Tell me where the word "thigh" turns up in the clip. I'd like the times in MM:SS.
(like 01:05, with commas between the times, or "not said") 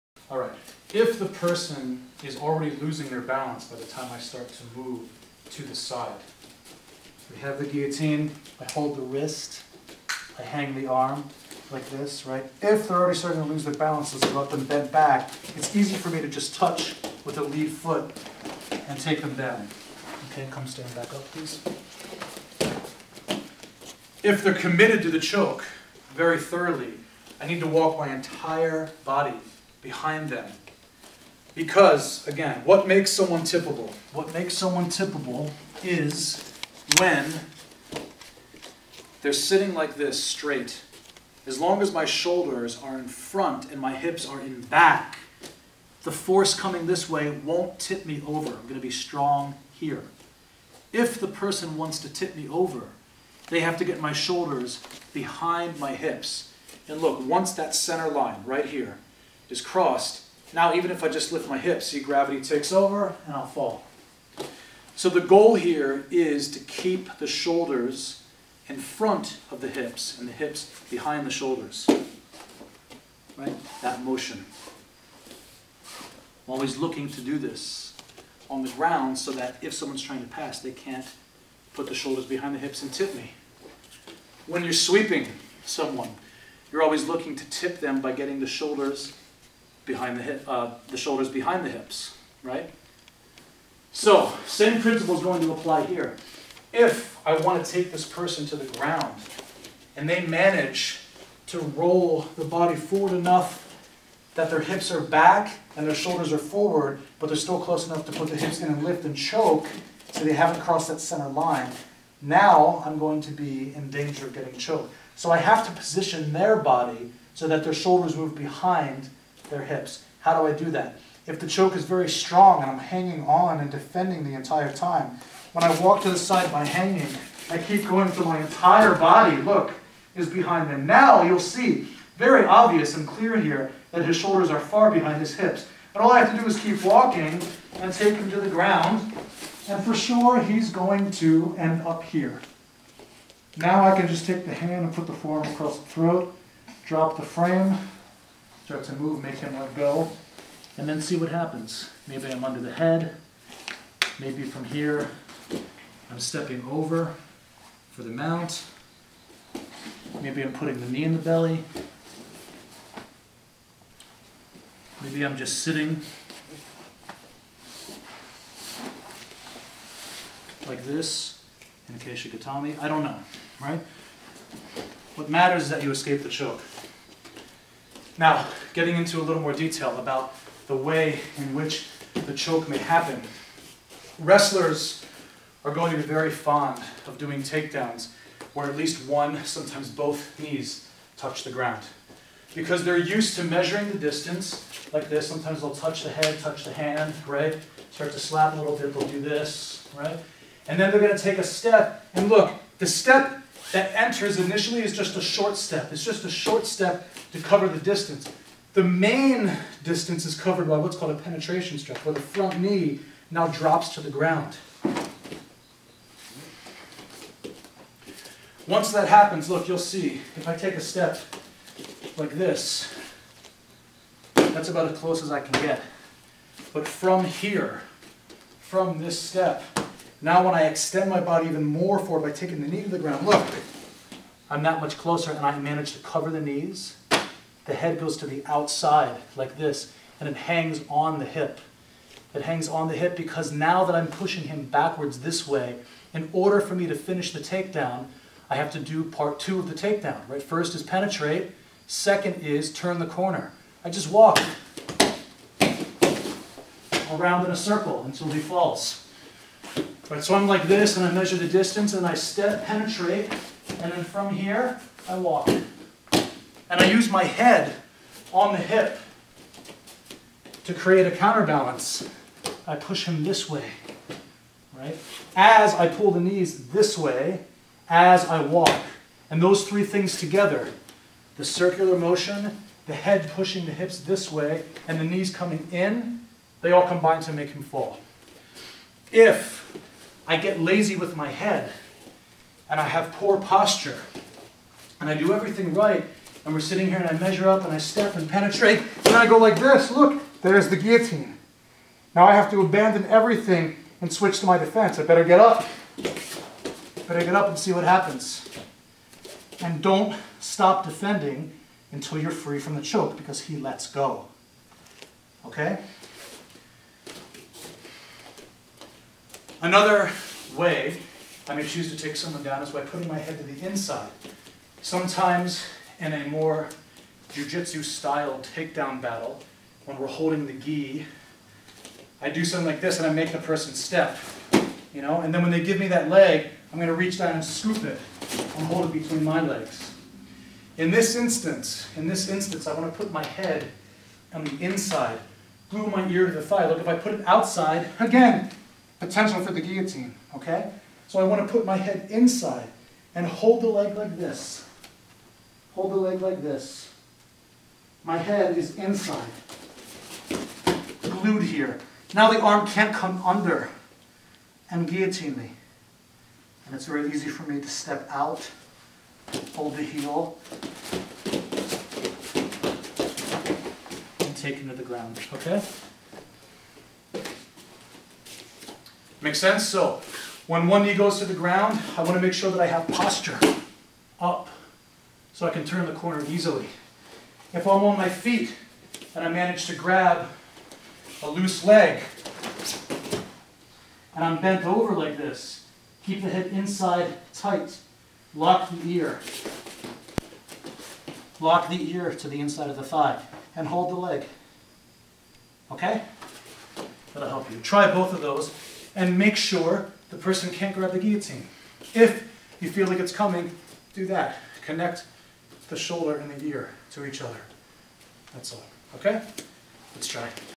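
05:46, 06:42.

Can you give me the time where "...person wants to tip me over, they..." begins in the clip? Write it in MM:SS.
00:51.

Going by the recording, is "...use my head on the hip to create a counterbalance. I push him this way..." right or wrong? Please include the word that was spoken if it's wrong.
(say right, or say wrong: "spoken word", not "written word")
right.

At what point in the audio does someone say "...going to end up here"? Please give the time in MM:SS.
02:20.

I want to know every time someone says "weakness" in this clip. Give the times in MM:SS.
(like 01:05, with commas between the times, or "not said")
not said.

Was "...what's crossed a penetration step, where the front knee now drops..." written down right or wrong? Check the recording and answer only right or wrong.
wrong.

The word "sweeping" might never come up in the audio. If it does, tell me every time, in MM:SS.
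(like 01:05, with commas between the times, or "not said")
01:24.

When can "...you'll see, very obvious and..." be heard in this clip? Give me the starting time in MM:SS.
02:11.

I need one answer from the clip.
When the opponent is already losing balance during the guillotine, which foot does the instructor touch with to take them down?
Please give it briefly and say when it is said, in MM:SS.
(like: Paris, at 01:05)
Lead foot, at 00:17.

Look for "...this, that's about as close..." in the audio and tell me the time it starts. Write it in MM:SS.
03:42.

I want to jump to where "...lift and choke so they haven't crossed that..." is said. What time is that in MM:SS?
01:48.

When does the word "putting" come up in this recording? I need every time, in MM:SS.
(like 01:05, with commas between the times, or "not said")
02:40, 05:22.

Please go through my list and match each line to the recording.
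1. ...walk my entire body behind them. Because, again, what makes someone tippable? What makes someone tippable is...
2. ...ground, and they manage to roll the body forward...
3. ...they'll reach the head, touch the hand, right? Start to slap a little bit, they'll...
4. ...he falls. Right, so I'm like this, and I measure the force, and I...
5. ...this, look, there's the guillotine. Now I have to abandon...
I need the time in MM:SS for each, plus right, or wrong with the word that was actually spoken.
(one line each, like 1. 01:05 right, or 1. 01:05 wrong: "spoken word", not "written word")
1. 00:27 right
2. 01:38 right
3. 03:15 wrong: "touch", not "reach"
4. 04:18 wrong: "distance", not "force"
5. 04:59 right.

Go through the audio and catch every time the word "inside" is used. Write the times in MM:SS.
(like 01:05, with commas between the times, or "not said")
05:23, 05:44, 05:52, 05:58, 06:36, 06:42.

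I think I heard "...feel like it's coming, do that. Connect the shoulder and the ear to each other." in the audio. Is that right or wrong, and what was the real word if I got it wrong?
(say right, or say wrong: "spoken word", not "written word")
right.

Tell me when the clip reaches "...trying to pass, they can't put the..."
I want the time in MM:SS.
01:20.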